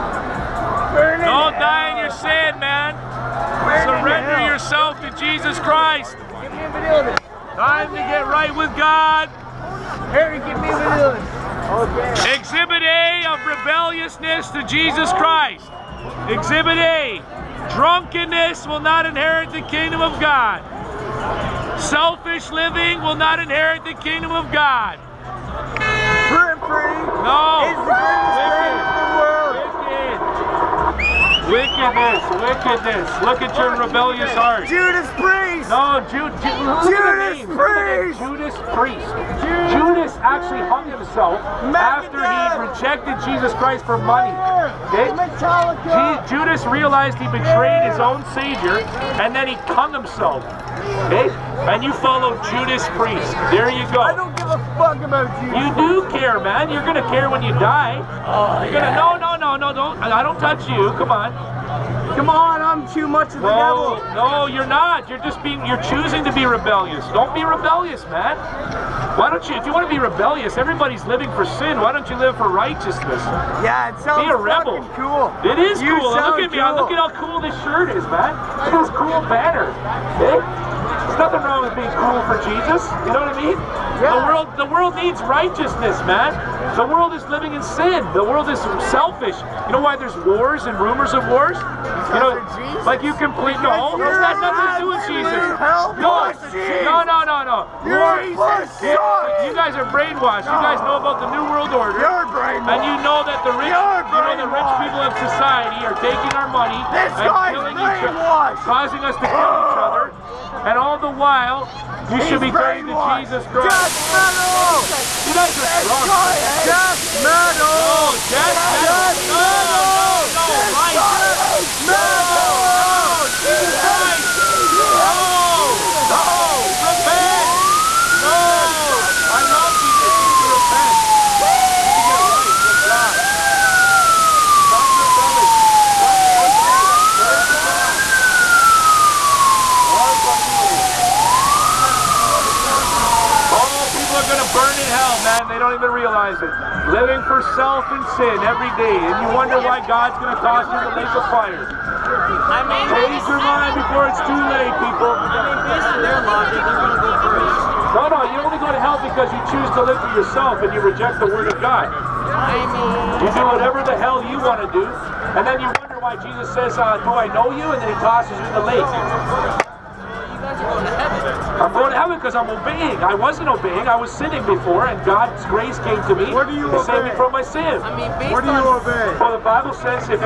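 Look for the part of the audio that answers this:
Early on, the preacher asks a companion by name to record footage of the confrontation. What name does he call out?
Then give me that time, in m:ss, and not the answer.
0:10.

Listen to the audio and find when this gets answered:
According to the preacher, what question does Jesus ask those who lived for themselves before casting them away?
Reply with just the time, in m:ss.
2:47.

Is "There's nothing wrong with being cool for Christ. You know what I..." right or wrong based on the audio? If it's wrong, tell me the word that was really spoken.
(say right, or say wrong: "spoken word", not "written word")
wrong: "Jesus", not "Christ".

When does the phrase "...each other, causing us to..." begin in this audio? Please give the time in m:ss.
1:47.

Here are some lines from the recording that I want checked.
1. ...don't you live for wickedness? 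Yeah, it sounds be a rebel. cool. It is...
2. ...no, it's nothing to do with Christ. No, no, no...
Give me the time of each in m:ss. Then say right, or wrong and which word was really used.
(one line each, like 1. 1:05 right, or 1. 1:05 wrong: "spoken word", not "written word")
1. 1:11 wrong: "righteousness", not "wickedness"
2. 1:33 wrong: "Jesus", not "Christ".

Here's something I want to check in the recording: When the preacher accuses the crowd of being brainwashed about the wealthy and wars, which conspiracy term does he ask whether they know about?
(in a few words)
New World Order.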